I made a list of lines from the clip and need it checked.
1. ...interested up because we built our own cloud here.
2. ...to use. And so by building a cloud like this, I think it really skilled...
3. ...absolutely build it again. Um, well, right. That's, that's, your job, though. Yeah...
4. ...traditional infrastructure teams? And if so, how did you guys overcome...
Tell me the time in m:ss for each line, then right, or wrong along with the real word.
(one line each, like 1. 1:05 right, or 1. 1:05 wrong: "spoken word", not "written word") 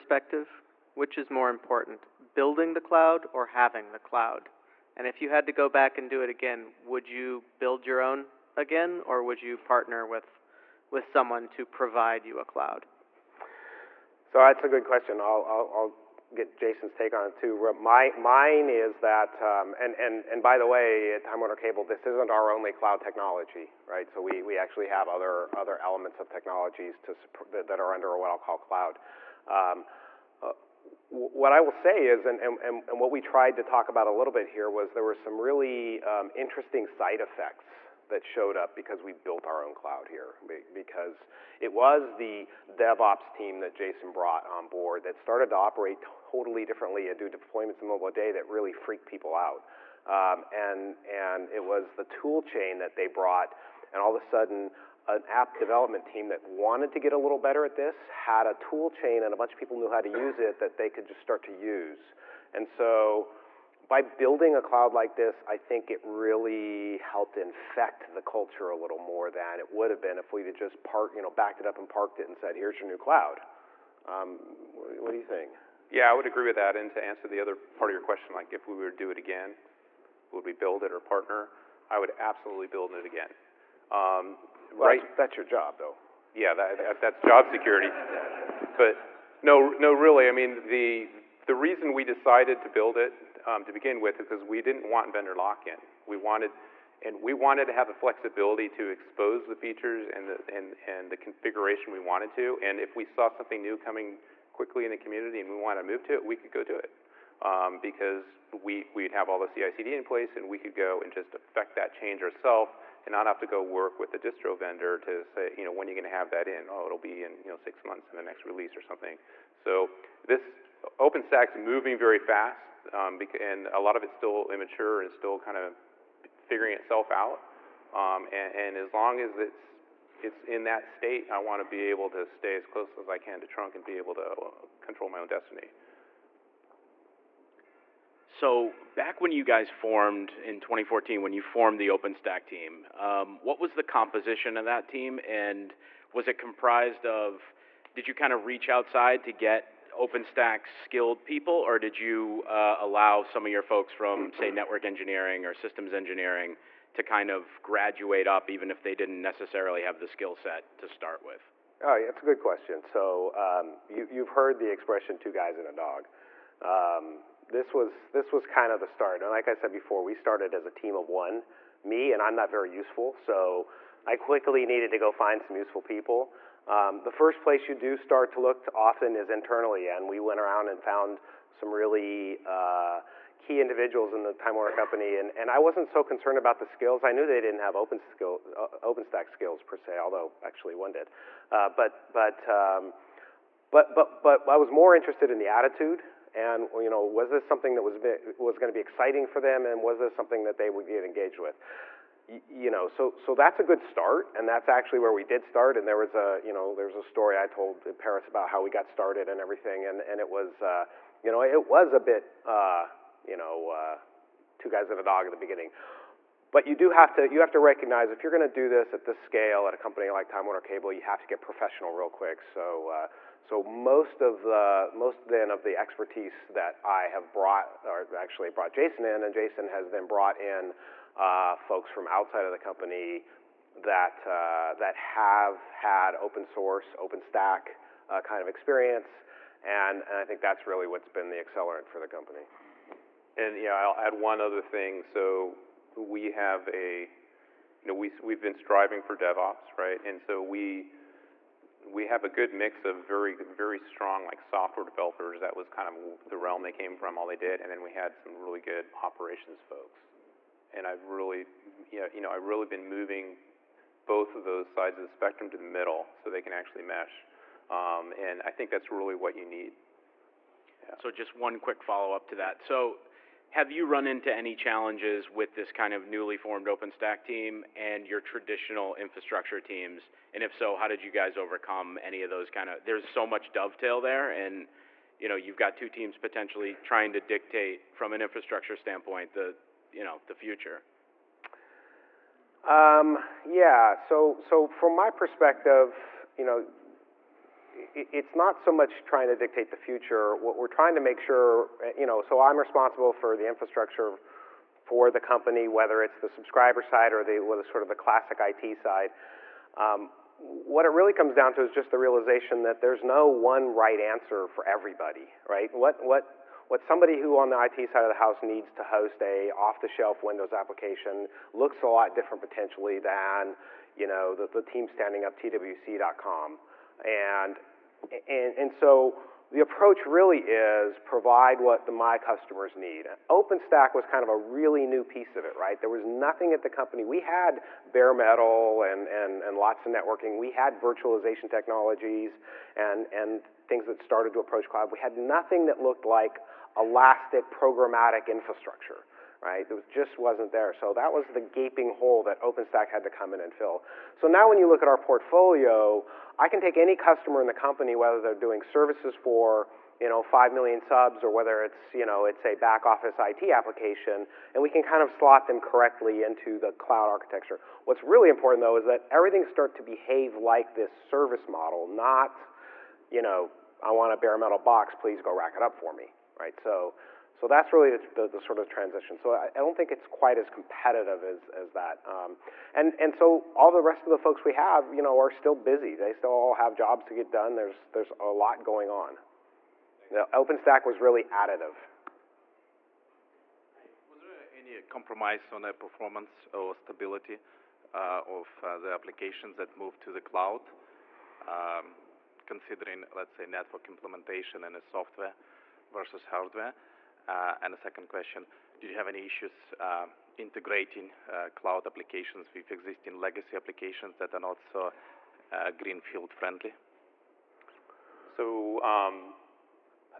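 1. 0:38 wrong: "showed", not "interested"
2. 1:01 wrong: "helped", not "skilled"
3. 1:22 right
4. 4:38 right.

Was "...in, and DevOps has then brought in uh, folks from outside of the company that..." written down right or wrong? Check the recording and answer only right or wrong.
wrong.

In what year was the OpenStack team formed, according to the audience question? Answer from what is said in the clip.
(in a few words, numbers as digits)
2014.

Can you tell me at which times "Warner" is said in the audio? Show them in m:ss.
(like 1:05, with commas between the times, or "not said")
0:21, 3:04, 3:40.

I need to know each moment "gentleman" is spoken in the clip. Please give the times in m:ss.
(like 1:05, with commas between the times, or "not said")
not said.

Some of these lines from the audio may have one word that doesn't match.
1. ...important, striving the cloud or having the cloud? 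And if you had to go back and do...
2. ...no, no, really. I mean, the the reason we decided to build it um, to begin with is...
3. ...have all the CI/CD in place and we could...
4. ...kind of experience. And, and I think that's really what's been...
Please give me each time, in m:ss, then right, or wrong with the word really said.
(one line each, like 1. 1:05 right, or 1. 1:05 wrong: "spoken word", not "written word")
1. 0:01 wrong: "building", not "striving"
2. 1:29 right
3. 1:49 right
4. 3:58 right.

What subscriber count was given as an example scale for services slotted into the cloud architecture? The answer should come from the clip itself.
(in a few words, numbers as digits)
5 million.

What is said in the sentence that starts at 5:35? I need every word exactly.
There was nothing at the company.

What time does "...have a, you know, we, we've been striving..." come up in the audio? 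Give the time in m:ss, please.
4:06.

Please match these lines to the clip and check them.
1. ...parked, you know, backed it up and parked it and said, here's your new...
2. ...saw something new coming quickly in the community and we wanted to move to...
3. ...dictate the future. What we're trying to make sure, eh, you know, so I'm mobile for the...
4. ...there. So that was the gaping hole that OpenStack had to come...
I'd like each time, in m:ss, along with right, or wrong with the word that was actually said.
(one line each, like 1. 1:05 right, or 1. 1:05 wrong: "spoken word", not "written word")
1. 1:10 right
2. 1:43 right
3. 4:59 wrong: "responsible", not "mobile"
4. 5:50 right.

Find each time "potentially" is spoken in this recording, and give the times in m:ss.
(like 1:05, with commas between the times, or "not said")
4:46, 5:22.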